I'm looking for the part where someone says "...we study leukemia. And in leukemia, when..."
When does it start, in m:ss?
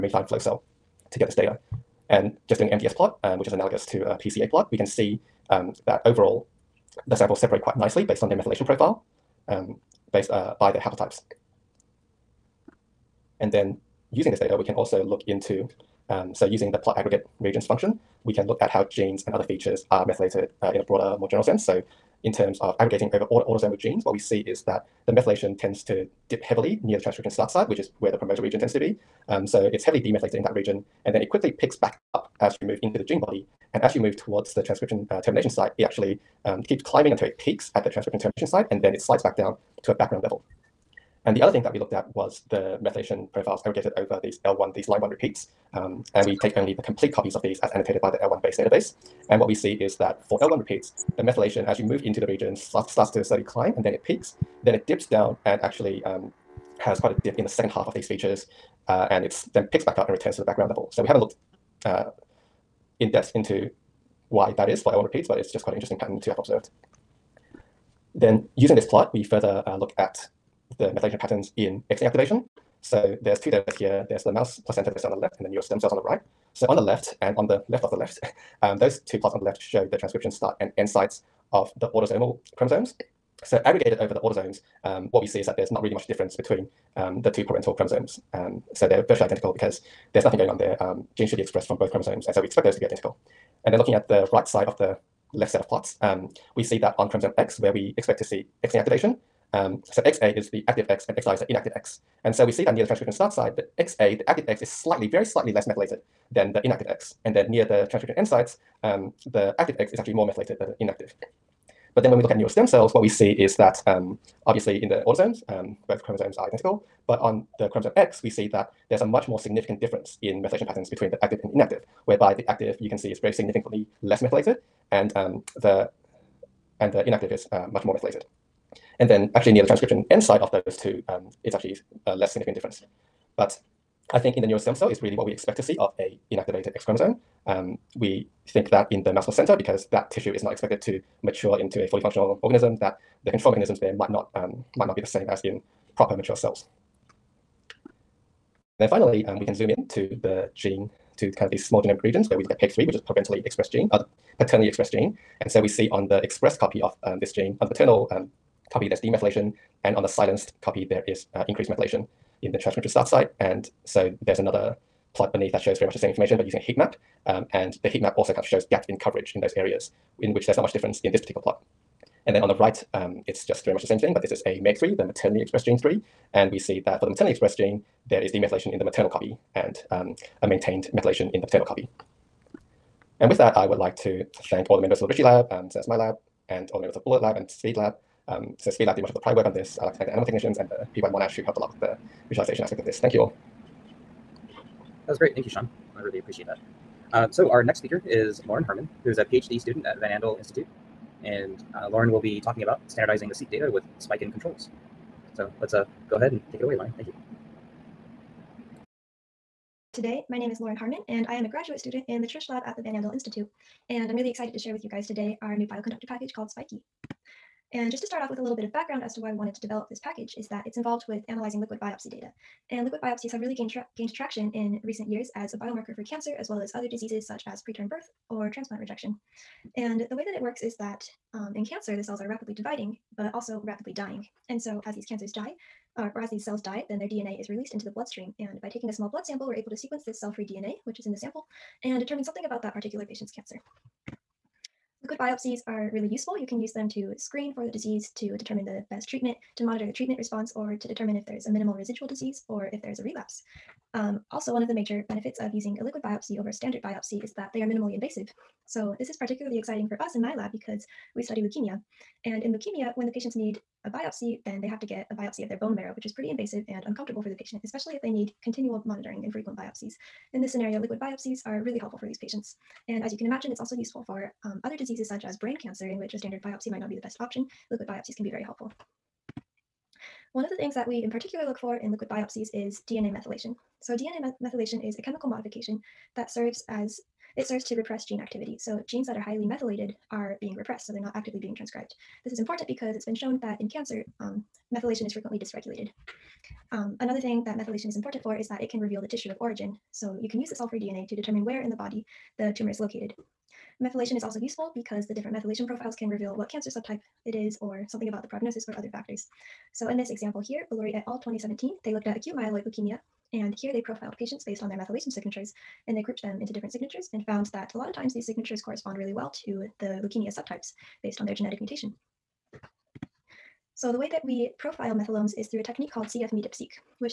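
4:21.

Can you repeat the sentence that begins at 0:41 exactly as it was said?
And the other thing that we looked at was the methylation profiles aggregated over these L1, these line one repeats.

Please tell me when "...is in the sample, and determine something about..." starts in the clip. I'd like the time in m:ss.
4:00.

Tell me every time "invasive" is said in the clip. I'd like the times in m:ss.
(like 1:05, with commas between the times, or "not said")
4:17, 4:26.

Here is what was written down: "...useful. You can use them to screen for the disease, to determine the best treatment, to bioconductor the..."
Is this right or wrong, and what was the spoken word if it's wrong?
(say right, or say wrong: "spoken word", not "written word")
wrong: "monitor", not "bioconductor".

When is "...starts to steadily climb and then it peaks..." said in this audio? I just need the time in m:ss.
0:52.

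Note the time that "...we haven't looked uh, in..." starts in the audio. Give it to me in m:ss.
1:01.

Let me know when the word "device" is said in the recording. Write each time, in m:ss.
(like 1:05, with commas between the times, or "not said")
not said.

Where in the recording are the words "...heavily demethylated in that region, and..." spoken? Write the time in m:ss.
0:29.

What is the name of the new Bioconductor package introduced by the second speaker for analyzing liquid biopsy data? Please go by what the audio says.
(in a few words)
Spiky.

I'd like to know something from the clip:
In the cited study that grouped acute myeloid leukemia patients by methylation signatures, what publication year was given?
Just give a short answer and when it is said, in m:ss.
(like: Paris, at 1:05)
2017, at 5:11.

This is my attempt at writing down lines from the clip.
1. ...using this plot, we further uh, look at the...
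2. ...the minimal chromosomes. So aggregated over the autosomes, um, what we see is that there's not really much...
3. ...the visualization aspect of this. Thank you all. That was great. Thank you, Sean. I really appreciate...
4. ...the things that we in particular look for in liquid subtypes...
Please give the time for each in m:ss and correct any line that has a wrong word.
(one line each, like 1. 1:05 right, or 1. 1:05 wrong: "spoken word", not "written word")
1. 1:08 right
2. 1:21 wrong: "autosomal", not "minimal"
3. 3:11 right
4. 4:40 wrong: "biopsies", not "subtypes".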